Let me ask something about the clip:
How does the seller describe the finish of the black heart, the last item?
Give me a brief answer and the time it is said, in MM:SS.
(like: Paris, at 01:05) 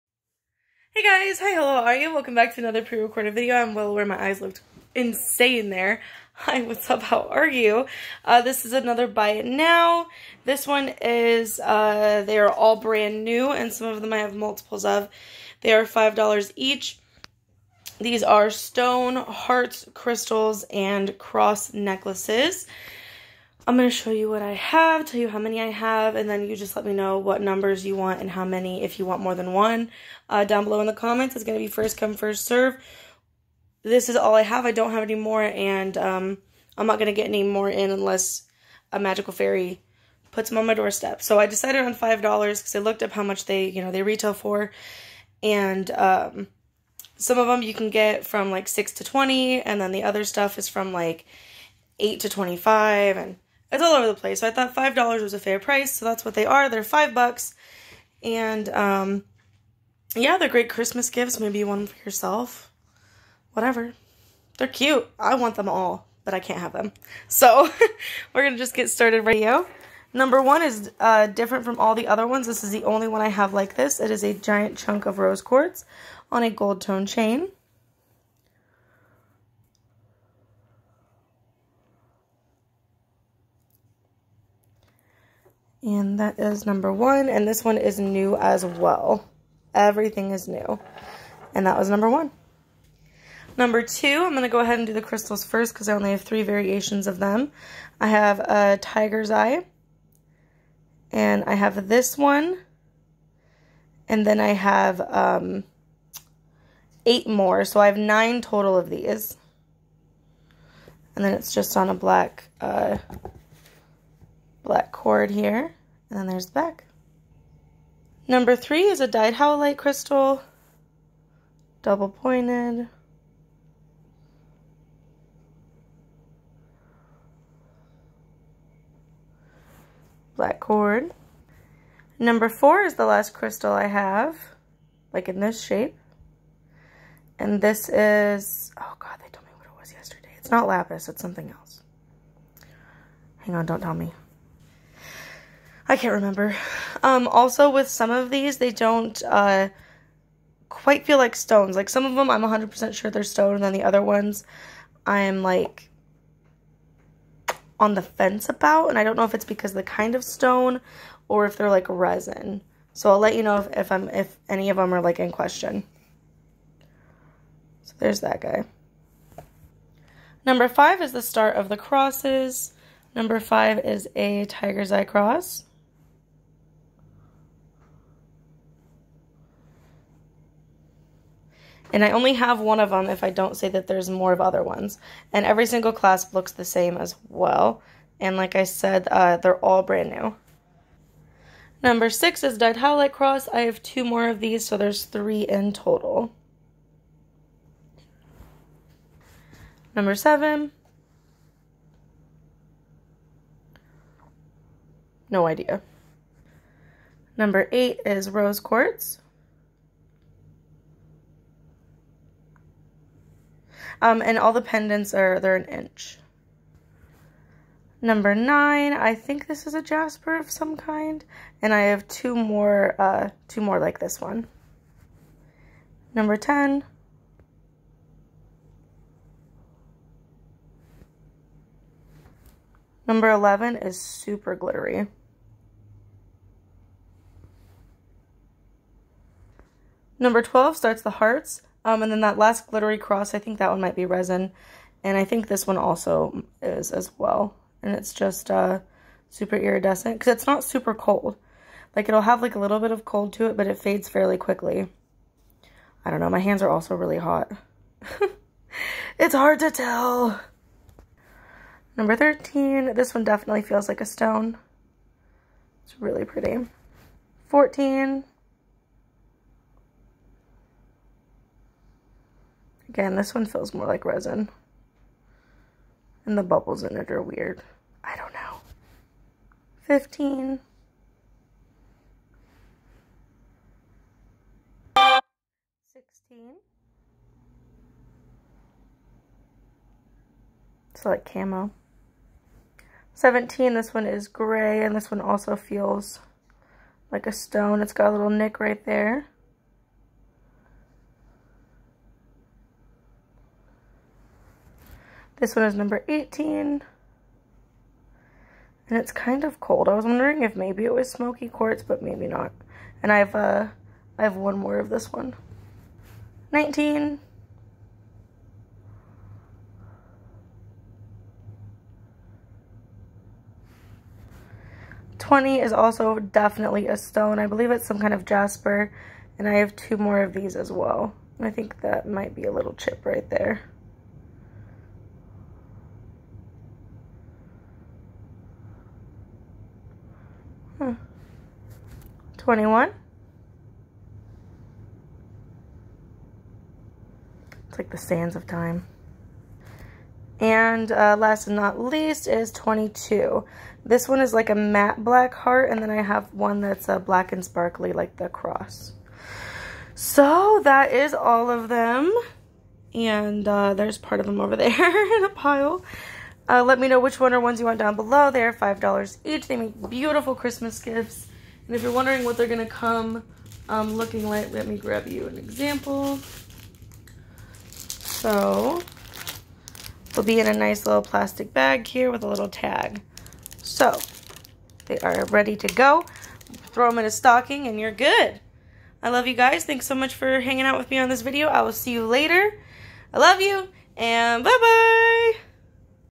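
Matte black, at 05:54.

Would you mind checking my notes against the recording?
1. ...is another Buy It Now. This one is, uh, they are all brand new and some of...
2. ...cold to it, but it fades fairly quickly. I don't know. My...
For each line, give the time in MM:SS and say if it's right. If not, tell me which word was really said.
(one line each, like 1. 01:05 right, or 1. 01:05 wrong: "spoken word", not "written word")
1. 00:08 right
2. 04:13 right.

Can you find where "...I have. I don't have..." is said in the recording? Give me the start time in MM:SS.
00:34.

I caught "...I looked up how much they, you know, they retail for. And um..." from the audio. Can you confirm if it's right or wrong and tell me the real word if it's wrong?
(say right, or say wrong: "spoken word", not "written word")
right.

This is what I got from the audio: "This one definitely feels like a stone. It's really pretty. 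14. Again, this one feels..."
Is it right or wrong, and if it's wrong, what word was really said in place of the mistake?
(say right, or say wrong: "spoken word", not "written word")
right.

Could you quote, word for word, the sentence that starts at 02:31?
Like some of them, I'm 100% sure they're stone, and then the other ones, I'm like on the fence about.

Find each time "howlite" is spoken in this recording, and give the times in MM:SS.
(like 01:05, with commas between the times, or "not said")
01:59, 03:12.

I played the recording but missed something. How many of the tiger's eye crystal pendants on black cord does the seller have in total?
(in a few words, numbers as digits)
9.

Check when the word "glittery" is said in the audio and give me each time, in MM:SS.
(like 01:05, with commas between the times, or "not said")
03:54, 04:02.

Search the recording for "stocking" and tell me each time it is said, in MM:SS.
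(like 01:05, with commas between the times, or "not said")
06:27.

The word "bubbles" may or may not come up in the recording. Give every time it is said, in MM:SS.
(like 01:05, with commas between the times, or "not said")
04:36.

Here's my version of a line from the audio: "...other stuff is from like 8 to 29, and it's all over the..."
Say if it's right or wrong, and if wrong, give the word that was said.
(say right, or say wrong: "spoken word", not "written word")
wrong: "25", not "29".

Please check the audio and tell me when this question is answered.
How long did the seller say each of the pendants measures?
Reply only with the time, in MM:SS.
03:35.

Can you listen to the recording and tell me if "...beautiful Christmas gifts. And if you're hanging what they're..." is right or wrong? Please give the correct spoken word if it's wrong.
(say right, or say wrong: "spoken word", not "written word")
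wrong: "wondering", not "hanging".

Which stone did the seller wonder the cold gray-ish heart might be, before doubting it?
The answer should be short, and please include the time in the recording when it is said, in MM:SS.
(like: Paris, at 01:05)
Smoky quartz, at 05:11.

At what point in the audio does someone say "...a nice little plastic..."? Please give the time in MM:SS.
06:20.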